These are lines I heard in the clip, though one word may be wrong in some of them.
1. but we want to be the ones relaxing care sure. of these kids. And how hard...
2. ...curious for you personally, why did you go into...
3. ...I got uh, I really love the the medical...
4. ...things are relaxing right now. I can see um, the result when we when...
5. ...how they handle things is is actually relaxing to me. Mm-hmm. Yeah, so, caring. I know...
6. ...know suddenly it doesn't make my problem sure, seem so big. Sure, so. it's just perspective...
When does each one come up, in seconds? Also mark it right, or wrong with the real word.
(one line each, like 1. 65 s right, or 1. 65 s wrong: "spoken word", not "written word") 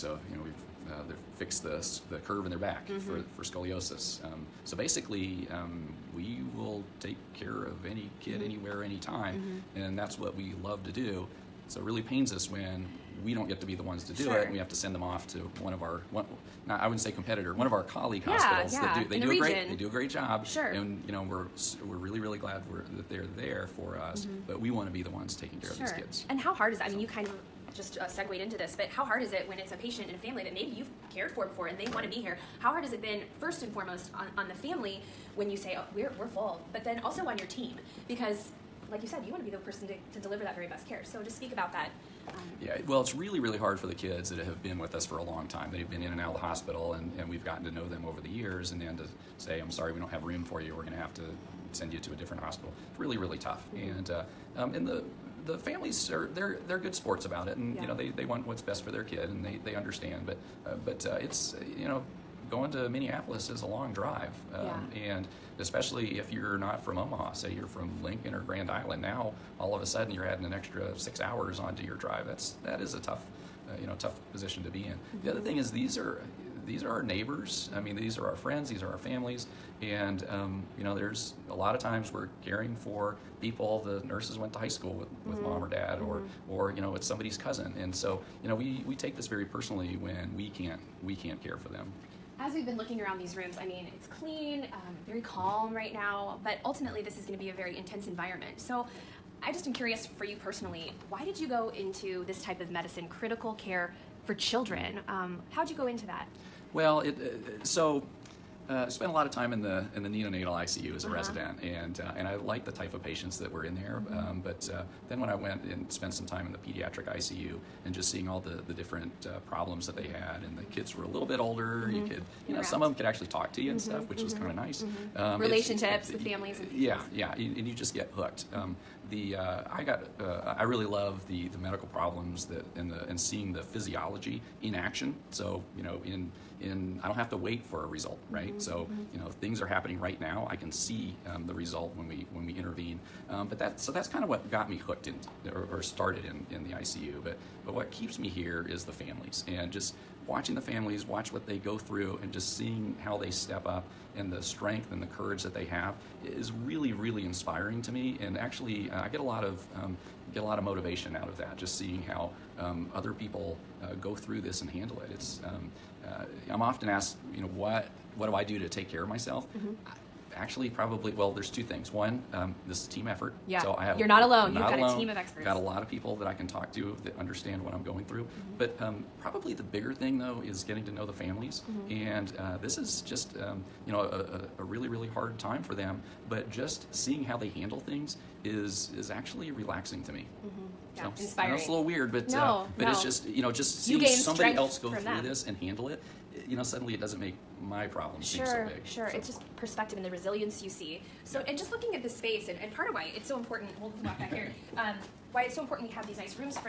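1. 24 s wrong: "taking", not "relaxing"
2. 99 s right
3. 129 s right
4. 139 s wrong: "happening", not "relaxing"
5. 187 s wrong: "inspiring", not "caring"
6. 196 s right.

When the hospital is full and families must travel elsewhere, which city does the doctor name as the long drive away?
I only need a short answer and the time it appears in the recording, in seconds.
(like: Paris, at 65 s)
Minneapolis, at 62 s.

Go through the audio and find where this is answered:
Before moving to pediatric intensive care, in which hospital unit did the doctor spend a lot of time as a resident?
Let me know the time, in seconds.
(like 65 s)
110 s.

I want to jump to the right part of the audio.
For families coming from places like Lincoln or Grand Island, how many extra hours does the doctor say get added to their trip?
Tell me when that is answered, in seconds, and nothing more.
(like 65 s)
70 s.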